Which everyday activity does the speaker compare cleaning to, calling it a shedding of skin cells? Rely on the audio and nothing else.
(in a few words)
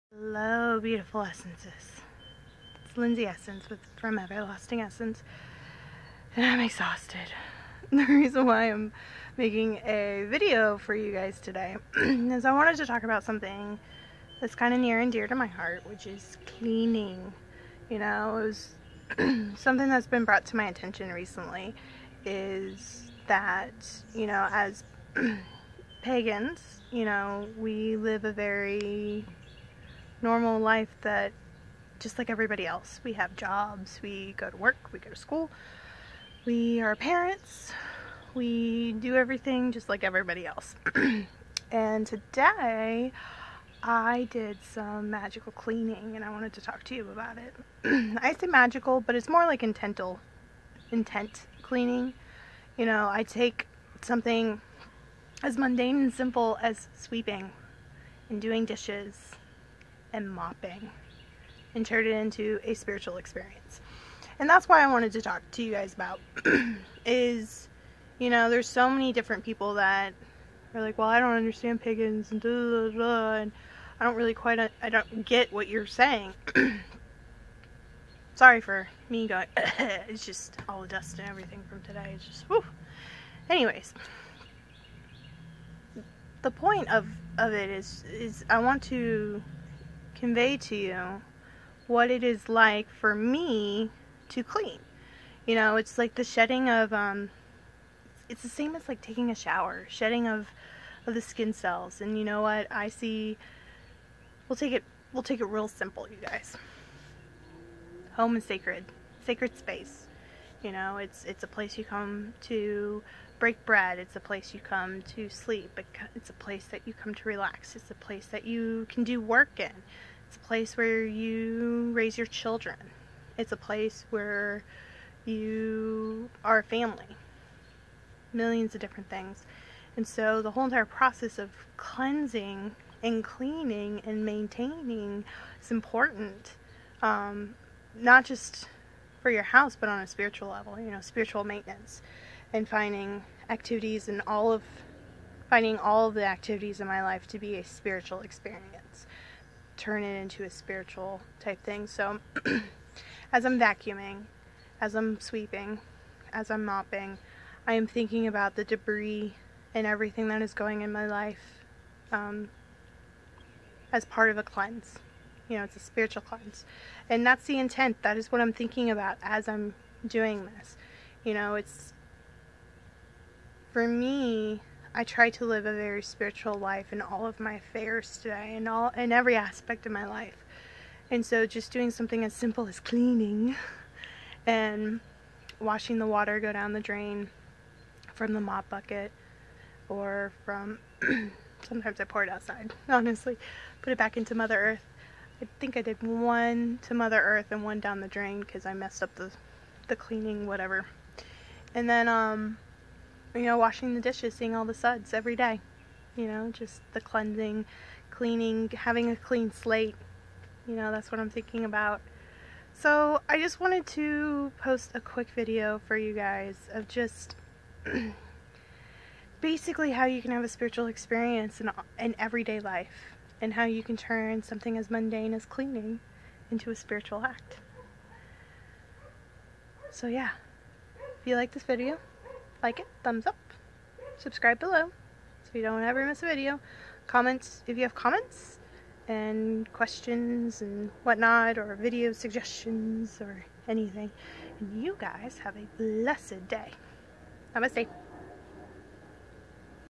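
taking a shower.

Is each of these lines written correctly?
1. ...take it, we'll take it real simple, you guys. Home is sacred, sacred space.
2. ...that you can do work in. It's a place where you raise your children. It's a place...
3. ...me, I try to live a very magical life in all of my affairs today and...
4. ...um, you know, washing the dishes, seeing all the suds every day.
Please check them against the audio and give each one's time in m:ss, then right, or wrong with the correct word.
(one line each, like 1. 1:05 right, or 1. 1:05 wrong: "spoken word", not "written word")
1. 1:44 right
2. 1:58 right
3. 2:53 wrong: "spiritual", not "magical"
4. 3:22 right.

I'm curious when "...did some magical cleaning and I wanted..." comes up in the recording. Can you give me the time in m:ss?
0:44.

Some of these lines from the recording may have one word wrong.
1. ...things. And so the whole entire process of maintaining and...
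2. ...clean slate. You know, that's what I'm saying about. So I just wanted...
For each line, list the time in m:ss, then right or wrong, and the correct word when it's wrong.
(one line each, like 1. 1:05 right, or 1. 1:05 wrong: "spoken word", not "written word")
1. 2:09 wrong: "cleansing", not "maintaining"
2. 3:29 wrong: "thinking", not "saying".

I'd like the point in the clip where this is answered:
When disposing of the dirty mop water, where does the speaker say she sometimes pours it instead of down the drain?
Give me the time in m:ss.
3:12.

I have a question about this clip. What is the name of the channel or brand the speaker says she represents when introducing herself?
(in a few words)
Everlasting Essence.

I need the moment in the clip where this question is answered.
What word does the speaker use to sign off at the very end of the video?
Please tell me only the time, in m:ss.
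4:07.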